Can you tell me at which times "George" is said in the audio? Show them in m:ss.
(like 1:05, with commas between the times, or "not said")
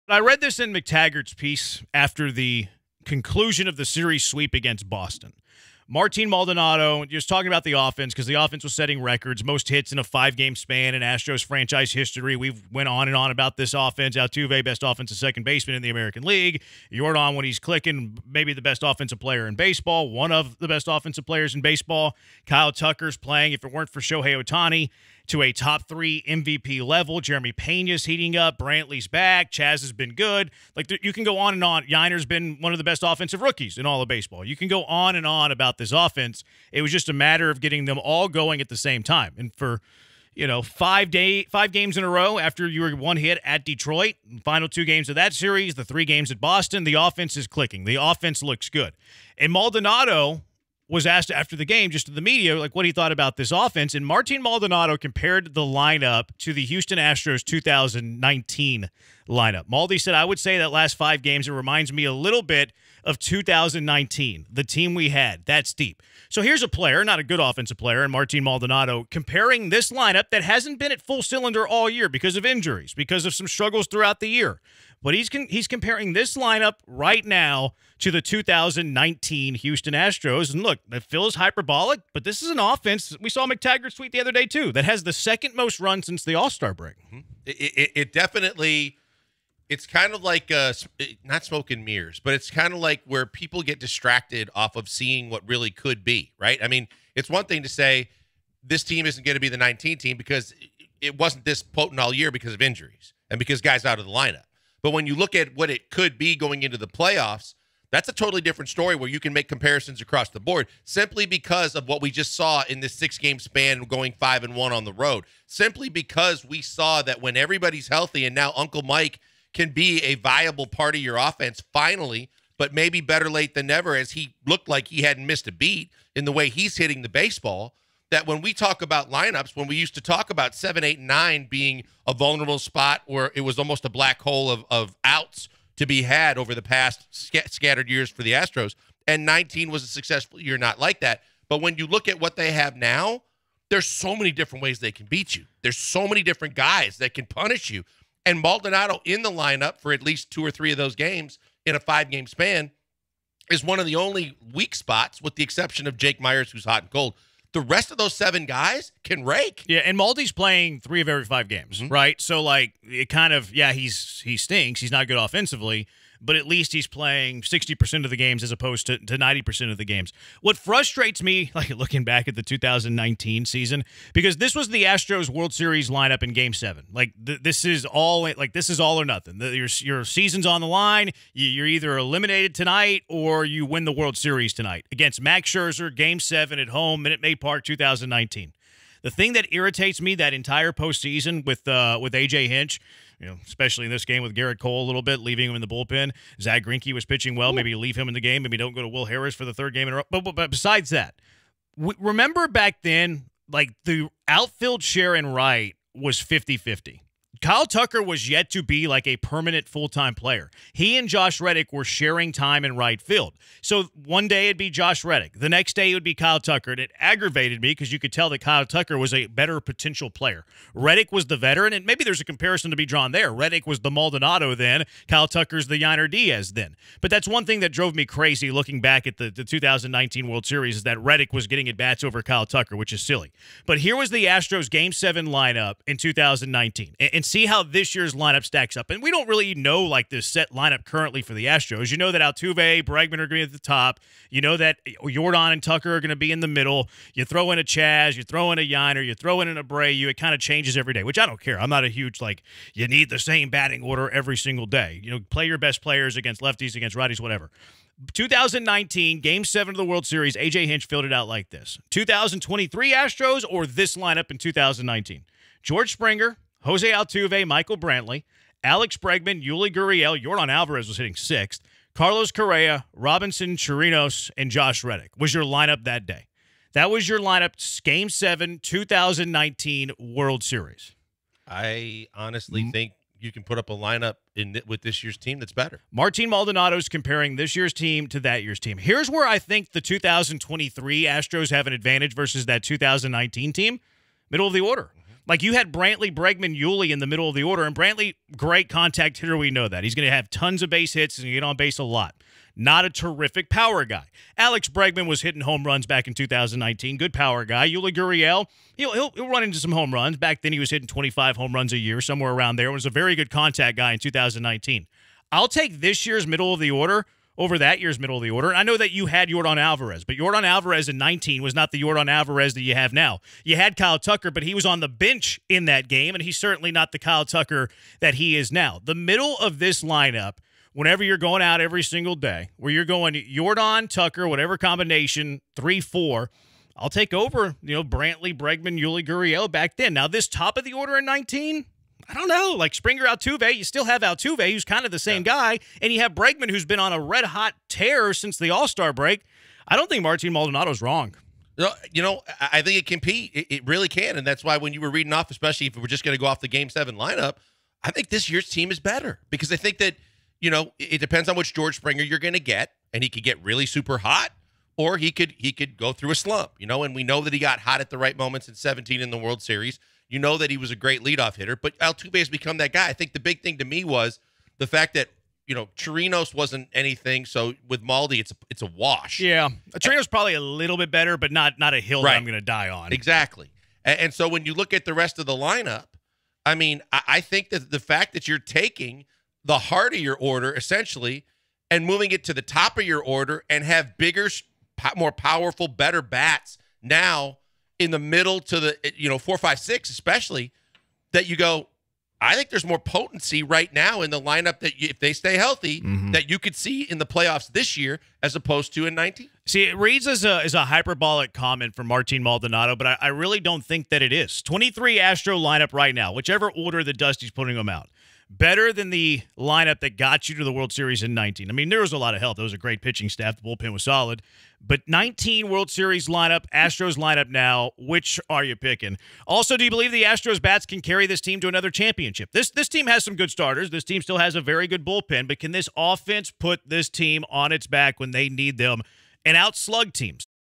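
4:25, 6:01.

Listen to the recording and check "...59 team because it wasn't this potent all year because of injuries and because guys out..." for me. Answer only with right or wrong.
wrong.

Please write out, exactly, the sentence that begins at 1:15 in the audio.
But he's con- he's comparing this lineup right now to the 2019 Houston Astros.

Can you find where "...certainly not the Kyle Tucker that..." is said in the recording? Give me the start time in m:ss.
5:26.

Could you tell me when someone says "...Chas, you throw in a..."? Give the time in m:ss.
4:07.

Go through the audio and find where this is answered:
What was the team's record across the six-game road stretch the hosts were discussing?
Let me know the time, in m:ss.
1:54.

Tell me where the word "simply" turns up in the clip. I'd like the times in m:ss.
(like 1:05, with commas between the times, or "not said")
1:50, 1:55.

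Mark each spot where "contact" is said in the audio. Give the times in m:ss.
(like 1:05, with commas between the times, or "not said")
4:58, 5:13.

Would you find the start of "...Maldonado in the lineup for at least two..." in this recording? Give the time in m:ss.
2:28.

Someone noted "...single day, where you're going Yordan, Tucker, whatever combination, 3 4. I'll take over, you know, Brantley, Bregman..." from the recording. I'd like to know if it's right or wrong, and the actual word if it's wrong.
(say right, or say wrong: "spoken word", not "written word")
right.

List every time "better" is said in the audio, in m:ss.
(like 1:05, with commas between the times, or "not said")
2:03, 3:39, 4:45, 5:58, 6:20, 6:35, 6:58.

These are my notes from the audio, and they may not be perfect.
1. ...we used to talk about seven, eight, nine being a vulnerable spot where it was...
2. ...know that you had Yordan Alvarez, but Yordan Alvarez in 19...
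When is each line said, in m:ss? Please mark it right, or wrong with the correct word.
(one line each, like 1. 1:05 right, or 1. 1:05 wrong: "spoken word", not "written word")
1. 2:09 right
2. 5:18 right.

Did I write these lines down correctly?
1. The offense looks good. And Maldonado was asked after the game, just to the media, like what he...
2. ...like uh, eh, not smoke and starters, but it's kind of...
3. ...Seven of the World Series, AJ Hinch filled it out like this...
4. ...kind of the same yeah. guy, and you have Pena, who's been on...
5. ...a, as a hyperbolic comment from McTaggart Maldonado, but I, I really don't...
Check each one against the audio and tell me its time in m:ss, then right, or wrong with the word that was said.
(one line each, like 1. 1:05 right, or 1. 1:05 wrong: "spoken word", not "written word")
1. 0:47 right
2. 1:30 wrong: "mirrors", not "starters"
3. 4:19 right
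4. 5:44 wrong: "Bregman", not "Pena"
5. 6:50 wrong: "Martin", not "McTaggart".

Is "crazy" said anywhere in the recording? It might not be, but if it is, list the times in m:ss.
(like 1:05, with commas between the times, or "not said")
3:48.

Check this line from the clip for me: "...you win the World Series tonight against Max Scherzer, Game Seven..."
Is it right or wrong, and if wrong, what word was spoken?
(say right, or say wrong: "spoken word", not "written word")
right.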